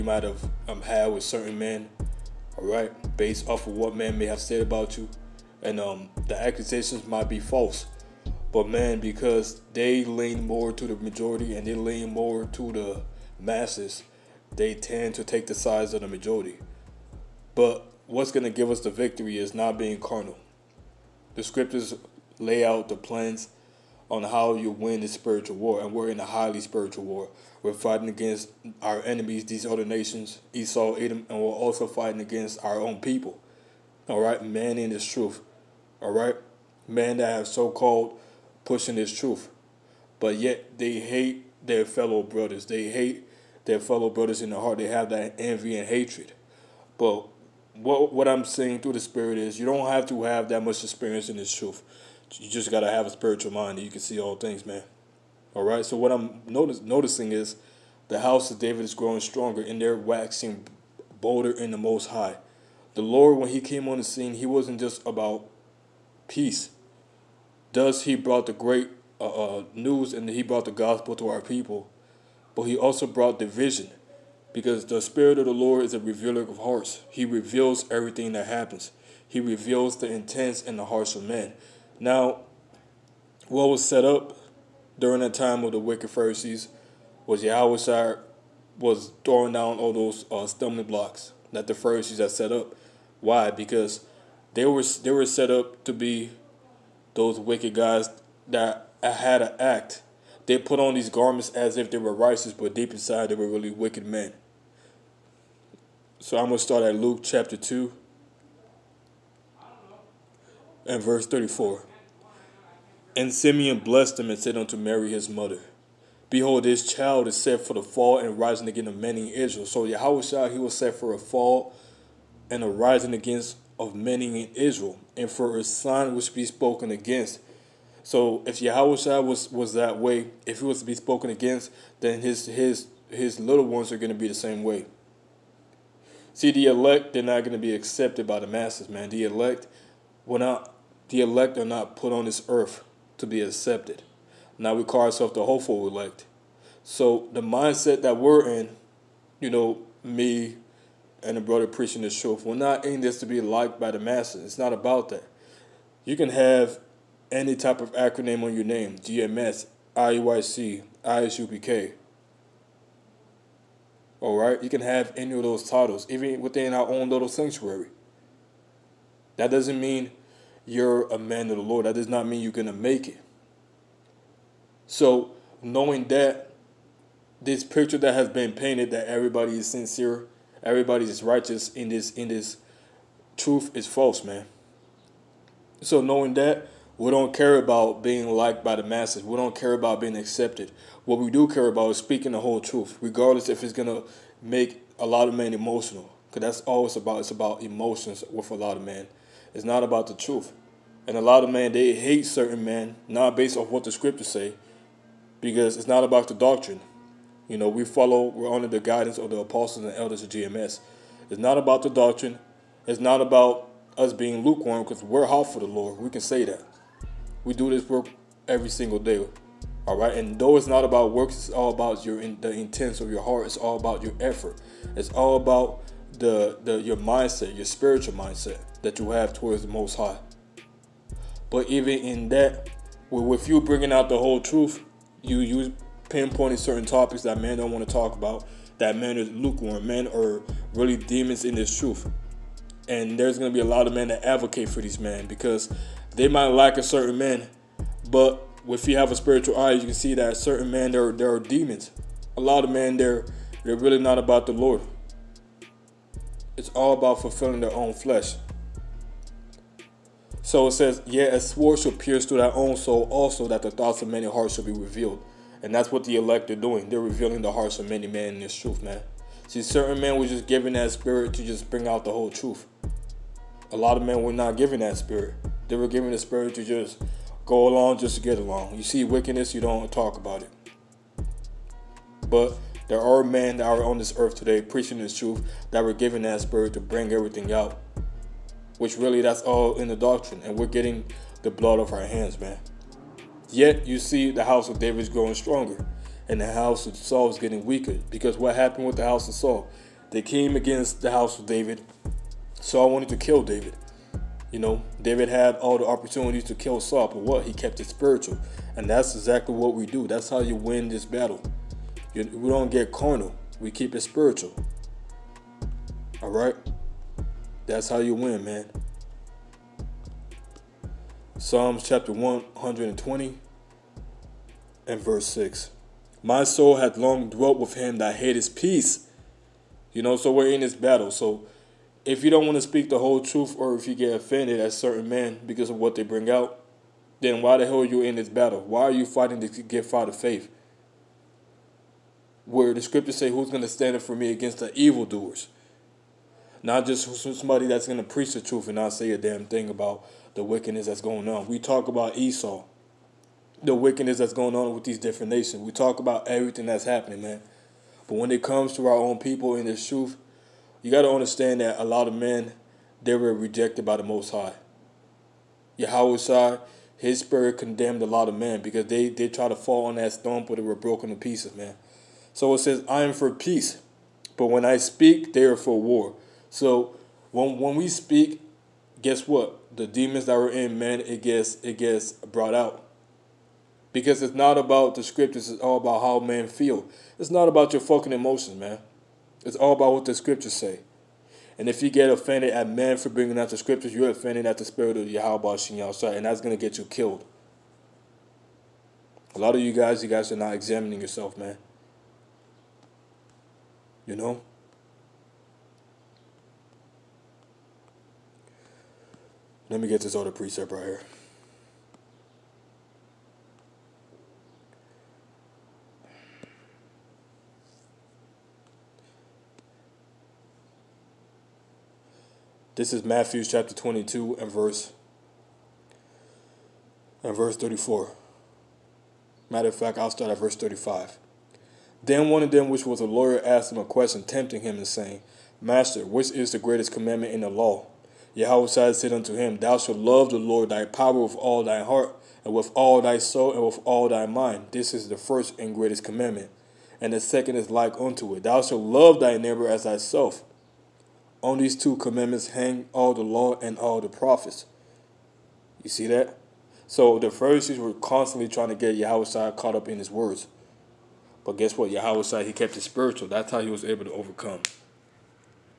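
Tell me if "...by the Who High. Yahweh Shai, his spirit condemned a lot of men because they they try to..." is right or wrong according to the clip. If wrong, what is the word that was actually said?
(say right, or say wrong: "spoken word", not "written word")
wrong: "Most", not "Who".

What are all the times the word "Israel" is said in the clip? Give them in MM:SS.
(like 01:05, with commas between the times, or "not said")
01:59, 02:04.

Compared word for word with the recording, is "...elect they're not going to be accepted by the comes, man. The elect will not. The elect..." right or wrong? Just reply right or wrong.
wrong.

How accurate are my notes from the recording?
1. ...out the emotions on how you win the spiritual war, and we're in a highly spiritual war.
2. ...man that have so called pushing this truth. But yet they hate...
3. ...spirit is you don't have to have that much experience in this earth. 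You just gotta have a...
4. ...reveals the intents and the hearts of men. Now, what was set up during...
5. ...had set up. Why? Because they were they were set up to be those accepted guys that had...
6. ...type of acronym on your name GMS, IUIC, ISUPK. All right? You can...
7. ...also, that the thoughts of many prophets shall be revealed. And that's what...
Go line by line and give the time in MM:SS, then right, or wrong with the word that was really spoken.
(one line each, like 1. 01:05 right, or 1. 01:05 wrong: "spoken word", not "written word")
1. 00:22 wrong: "plans", not "emotions"
2. 00:36 right
3. 00:48 wrong: "truth", not "earth"
4. 01:19 right
5. 01:32 wrong: "wicked", not "accepted"
6. 02:37 right
7. 04:23 wrong: "hearts", not "prophets".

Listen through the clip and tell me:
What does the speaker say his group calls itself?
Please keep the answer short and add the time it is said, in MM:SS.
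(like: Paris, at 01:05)
the hopeful elect, at 02:25.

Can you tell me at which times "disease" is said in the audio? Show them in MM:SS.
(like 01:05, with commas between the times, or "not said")
not said.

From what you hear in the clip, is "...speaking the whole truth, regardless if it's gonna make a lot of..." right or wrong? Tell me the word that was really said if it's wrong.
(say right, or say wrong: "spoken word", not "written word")
right.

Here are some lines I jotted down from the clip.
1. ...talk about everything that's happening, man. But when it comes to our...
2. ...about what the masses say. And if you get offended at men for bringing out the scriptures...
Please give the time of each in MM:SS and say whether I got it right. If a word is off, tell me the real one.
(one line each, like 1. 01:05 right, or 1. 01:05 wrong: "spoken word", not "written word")
1. 05:55 right
2. 06:29 wrong: "scriptures", not "masses".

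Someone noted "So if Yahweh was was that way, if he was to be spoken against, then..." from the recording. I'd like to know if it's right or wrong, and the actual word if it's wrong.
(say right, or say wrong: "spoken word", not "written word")
right.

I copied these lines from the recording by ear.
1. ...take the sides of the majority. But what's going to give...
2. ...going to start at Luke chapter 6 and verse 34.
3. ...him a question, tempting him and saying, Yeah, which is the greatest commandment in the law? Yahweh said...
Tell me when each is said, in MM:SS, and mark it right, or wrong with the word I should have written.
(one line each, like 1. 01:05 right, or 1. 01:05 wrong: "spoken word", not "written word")
1. 00:15 right
2. 01:46 wrong: "2", not "6"
3. 07:13 wrong: "Master", not "Yeah".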